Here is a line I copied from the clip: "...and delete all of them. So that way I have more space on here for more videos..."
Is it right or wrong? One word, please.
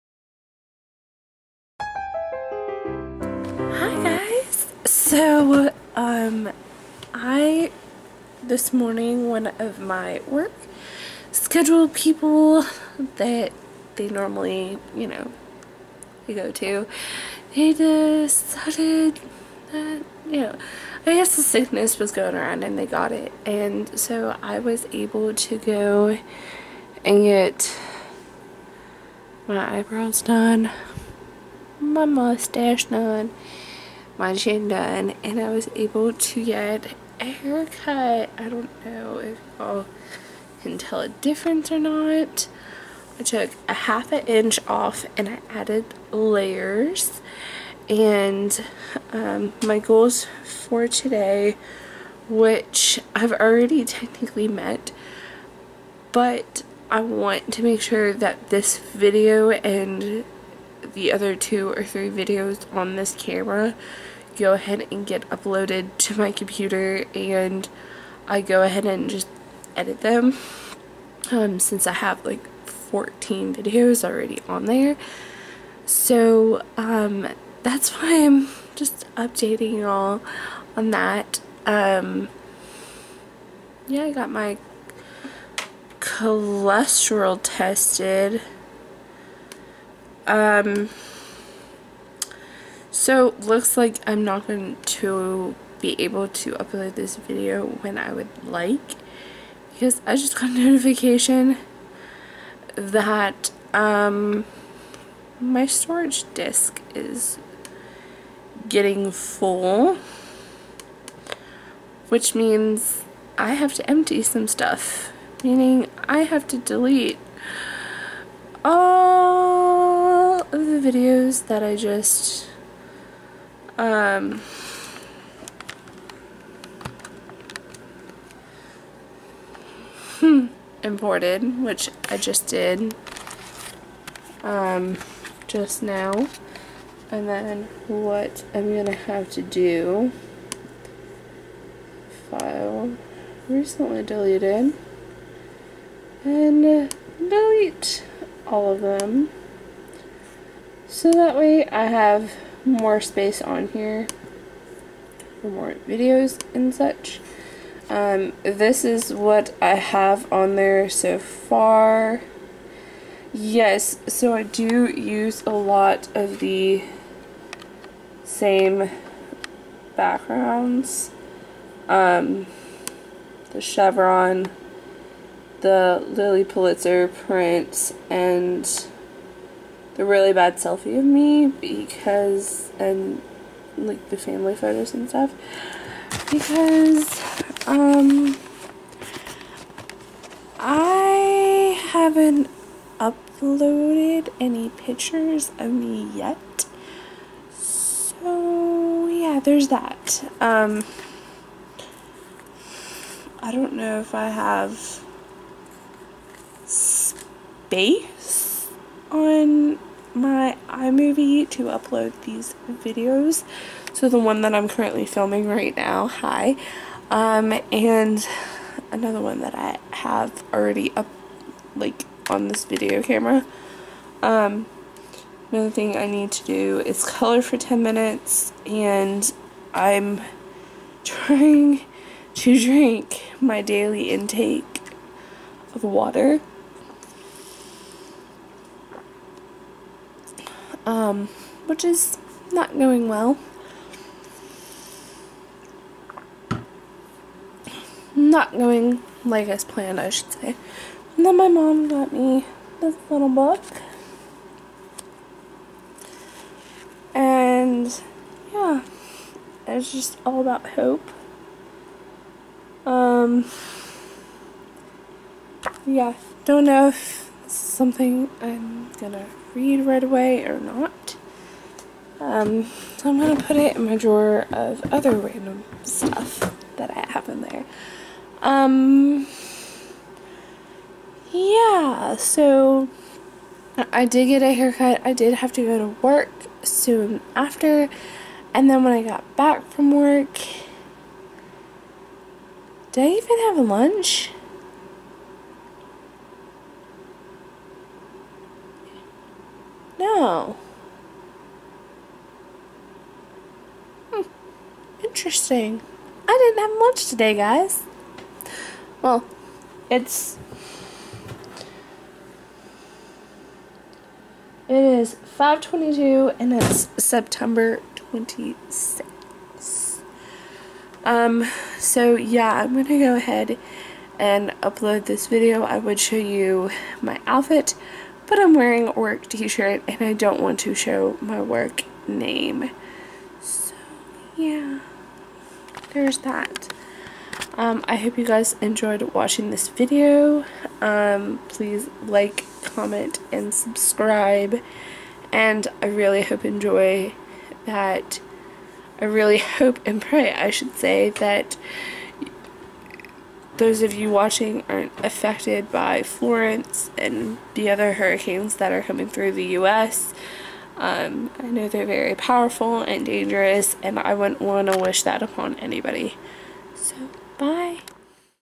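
right.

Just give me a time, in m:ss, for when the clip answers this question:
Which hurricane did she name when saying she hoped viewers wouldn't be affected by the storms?
5:56.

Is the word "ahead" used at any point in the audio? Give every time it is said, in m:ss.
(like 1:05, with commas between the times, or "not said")
1:04, 1:08, 5:23.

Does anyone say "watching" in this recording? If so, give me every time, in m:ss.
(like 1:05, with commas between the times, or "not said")
5:39, 5:54.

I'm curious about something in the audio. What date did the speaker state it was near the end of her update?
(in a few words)
September 26th.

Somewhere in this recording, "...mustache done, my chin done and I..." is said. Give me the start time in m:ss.
0:32.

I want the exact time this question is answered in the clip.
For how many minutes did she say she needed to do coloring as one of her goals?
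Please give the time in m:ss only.
3:47.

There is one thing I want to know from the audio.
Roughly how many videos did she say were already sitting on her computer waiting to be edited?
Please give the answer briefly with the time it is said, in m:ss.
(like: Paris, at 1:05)
14, at 1:12.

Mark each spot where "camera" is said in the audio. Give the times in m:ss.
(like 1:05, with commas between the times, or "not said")
1:03, 3:43.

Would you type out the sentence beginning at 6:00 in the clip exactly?
Um, I know they're very powerful and dangerous, and I wouldn't want to wish that upon anybody.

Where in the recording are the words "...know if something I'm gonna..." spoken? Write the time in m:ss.
4:26.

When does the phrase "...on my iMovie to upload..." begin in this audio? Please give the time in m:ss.
3:29.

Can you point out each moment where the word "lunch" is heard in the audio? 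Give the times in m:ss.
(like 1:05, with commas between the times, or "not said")
4:53, 5:06.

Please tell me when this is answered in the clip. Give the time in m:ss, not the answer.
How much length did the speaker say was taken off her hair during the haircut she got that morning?
0:43.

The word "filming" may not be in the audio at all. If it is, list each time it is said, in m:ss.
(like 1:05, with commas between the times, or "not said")
3:35.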